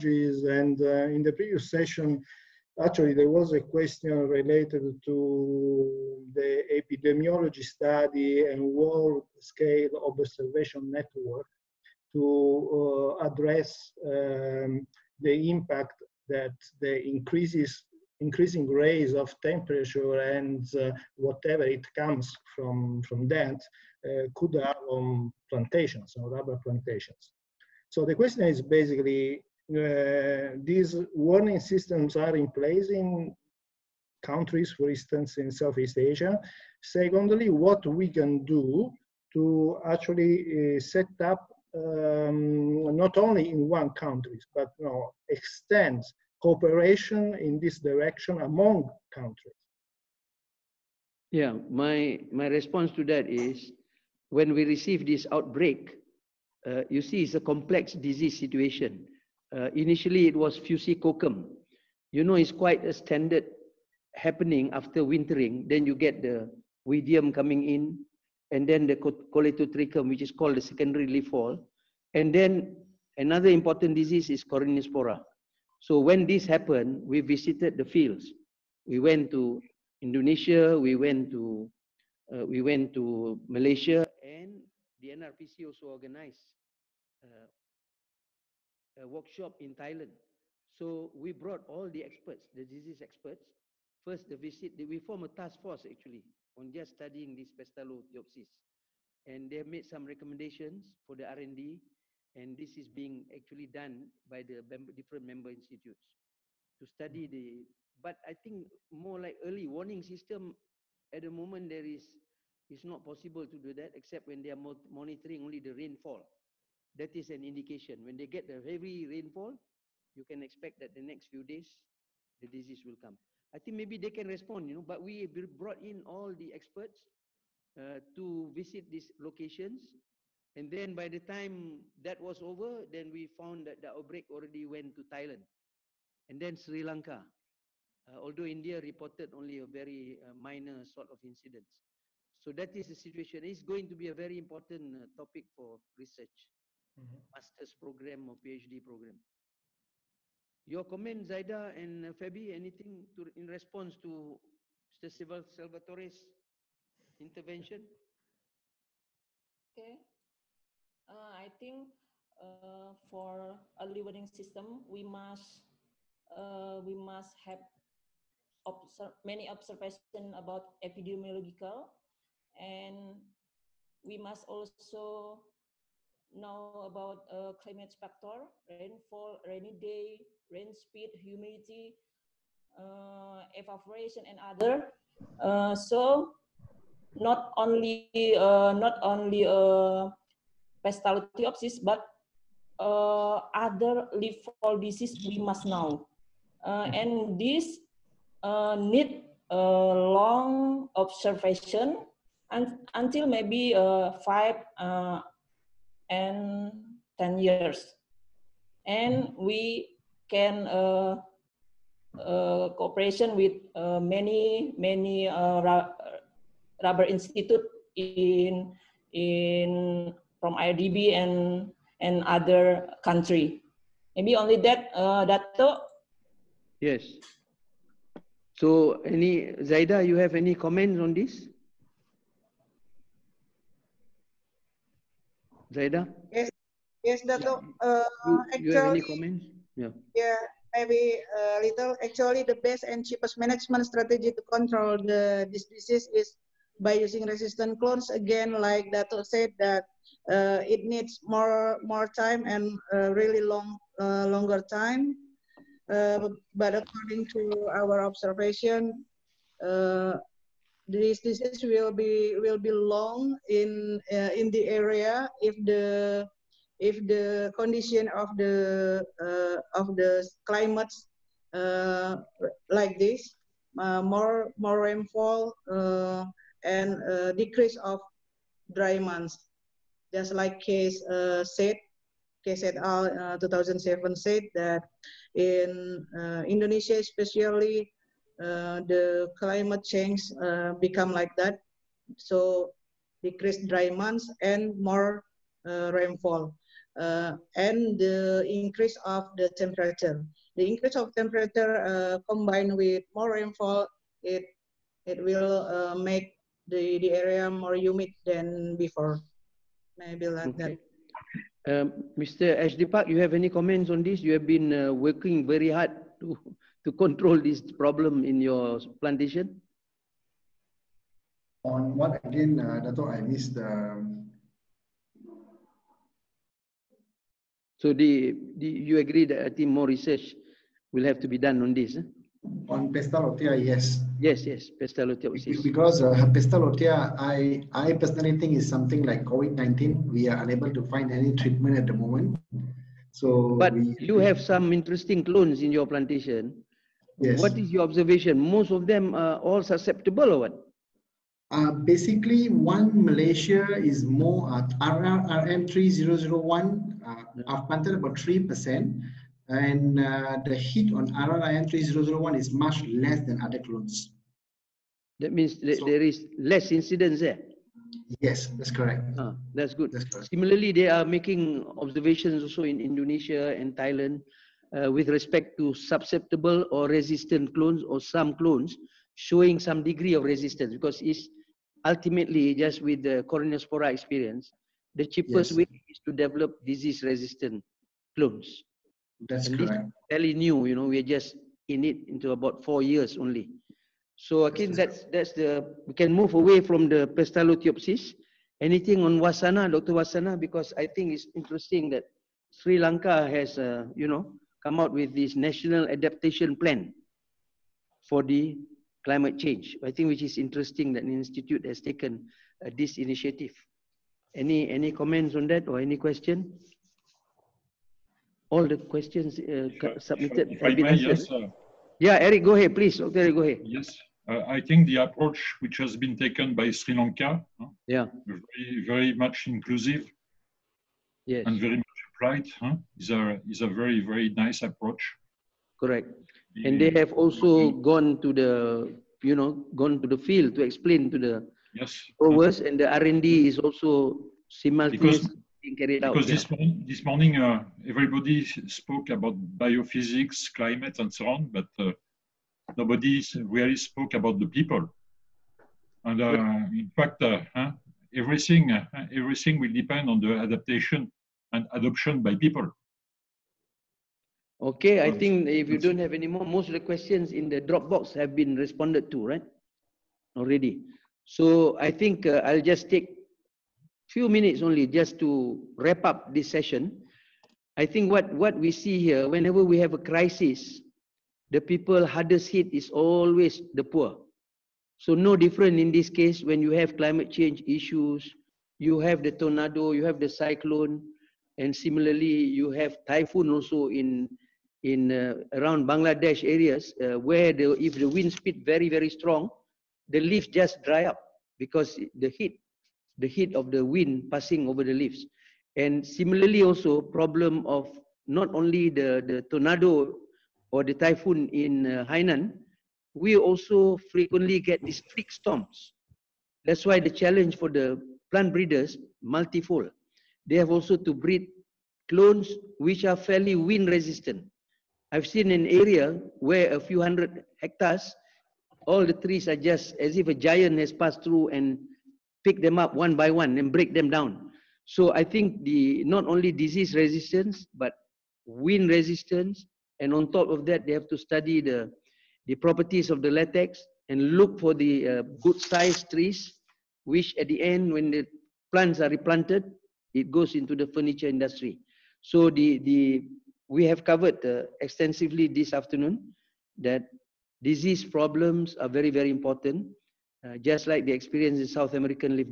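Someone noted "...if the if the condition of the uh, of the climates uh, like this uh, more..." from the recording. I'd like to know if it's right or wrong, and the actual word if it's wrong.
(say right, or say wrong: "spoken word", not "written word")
right.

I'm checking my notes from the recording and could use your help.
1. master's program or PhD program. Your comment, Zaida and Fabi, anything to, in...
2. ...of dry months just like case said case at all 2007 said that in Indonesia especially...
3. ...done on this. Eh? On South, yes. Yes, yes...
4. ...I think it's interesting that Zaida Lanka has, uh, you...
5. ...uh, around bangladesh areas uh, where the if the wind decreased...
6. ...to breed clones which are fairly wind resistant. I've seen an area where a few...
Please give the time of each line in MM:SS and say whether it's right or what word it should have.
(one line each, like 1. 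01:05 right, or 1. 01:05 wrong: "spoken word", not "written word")
1. 02:27 right
2. 04:37 right
3. 05:31 wrong: "Pestalotia", not "South"
4. 06:40 wrong: "Sri", not "Zaida"
5. 08:15 wrong: "speed", not "decreased"
6. 08:40 right.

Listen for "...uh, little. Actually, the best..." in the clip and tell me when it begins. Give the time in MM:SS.
04:01.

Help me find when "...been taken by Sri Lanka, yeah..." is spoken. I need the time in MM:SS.
07:05.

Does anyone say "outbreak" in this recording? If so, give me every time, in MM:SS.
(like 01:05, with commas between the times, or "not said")
00:55, 02:13.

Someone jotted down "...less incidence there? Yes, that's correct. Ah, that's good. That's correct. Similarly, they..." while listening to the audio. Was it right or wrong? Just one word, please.
right.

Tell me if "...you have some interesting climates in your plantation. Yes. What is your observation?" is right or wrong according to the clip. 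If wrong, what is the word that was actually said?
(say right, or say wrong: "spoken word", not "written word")
wrong: "clones", not "climates".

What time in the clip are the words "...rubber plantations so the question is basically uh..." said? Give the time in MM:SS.
00:26.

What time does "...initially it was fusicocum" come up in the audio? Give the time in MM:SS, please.
00:59.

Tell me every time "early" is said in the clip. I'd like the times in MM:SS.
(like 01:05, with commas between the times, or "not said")
01:49, 02:43.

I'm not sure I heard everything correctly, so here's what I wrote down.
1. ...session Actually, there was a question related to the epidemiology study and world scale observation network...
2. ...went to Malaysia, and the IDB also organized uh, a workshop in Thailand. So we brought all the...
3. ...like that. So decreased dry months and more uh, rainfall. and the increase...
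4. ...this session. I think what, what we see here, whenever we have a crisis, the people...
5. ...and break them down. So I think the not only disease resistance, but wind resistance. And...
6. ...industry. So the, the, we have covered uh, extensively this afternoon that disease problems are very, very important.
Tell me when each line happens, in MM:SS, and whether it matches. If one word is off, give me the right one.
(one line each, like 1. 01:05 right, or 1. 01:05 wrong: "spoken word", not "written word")
1. 00:01 right
2. 01:22 wrong: "NRPC", not "IDB"
3. 04:51 right
4. 07:56 right
5. 08:53 right
6. 09:11 right.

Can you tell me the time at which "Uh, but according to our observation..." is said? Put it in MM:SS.
04:15.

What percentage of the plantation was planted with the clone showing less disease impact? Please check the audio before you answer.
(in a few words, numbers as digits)
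3%.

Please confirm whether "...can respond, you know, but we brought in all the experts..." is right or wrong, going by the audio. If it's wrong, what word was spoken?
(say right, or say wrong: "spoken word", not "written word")
right.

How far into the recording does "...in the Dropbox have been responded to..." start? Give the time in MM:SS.
07:47.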